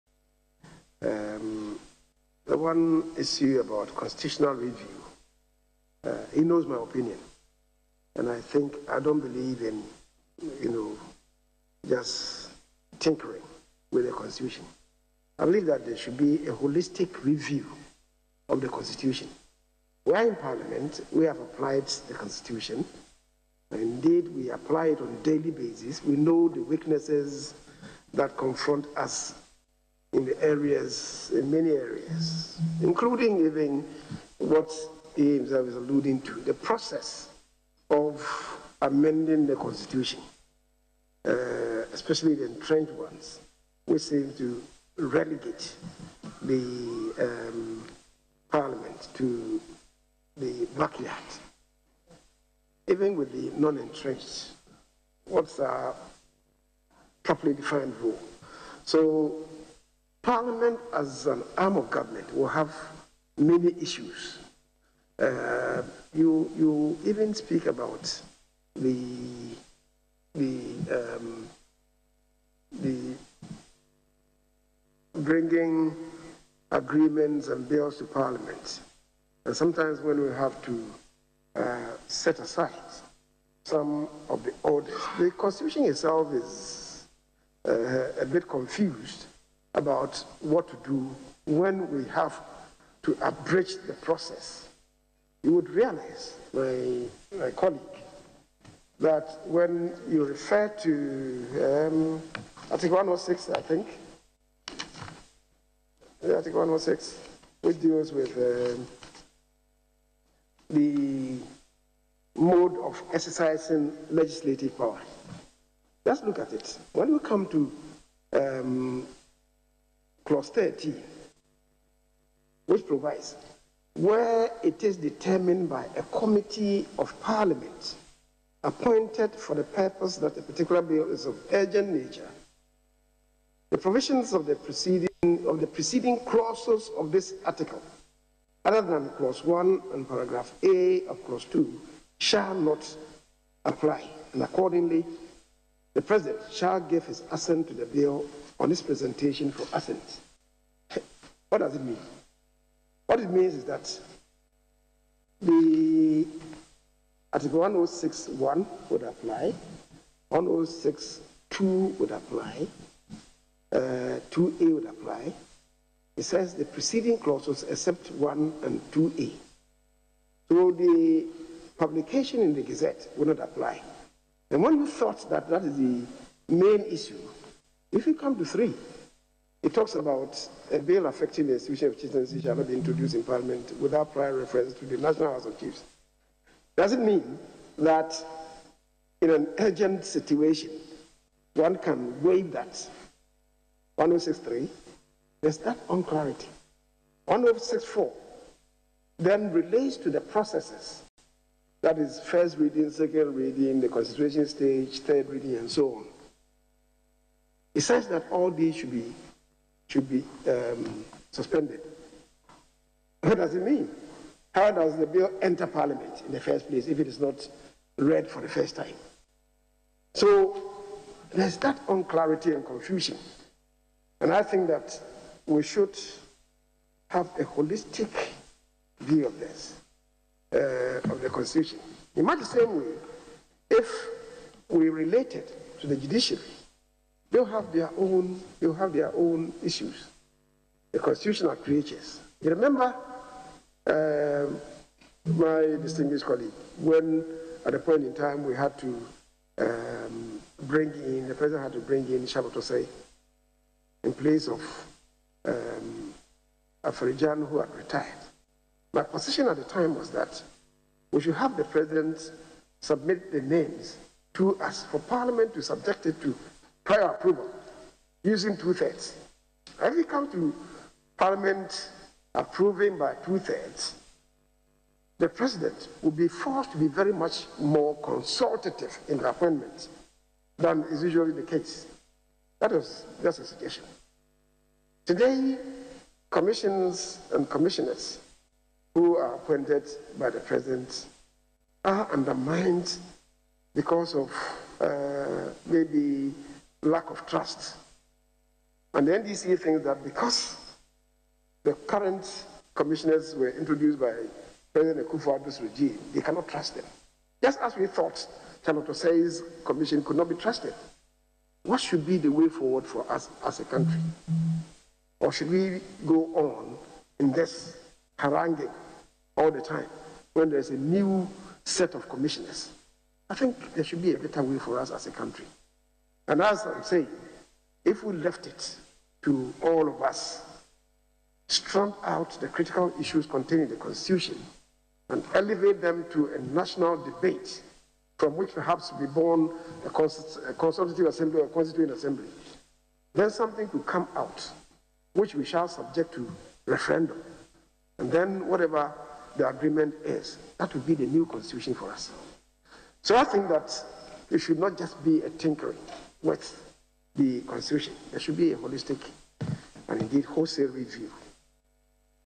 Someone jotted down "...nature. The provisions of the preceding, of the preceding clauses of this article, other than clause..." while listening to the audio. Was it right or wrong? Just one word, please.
right.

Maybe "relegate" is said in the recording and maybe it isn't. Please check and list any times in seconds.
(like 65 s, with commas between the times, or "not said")
44 s.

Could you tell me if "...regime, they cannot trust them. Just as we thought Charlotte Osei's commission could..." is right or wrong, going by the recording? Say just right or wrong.
right.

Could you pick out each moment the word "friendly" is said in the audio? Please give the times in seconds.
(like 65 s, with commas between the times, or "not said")
not said.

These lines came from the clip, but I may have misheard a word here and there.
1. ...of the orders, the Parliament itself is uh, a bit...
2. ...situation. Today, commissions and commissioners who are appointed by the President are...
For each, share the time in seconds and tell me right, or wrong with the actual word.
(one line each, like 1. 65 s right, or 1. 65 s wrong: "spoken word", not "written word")
1. 84 s wrong: "Constitution", not "Parliament"
2. 283 s right.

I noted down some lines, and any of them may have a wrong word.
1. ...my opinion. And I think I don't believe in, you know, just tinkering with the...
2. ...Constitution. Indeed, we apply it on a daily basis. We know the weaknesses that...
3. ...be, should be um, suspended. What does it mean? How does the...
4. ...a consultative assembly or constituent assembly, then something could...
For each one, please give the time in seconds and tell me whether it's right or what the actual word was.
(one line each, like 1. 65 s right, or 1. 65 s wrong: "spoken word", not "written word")
1. 6 s right
2. 22 s right
3. 208 s right
4. 339 s right.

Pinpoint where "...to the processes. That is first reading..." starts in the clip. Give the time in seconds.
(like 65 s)
199 s.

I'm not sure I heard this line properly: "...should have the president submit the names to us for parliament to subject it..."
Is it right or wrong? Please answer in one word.
right.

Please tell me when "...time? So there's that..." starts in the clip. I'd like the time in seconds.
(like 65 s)
218 s.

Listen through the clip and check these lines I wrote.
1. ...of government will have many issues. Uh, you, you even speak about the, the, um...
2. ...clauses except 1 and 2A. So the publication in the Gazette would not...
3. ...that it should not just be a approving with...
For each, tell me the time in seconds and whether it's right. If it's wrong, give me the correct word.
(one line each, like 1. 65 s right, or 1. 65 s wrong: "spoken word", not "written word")
1. 61 s right
2. 167 s right
3. 353 s wrong: "tinkering", not "approving".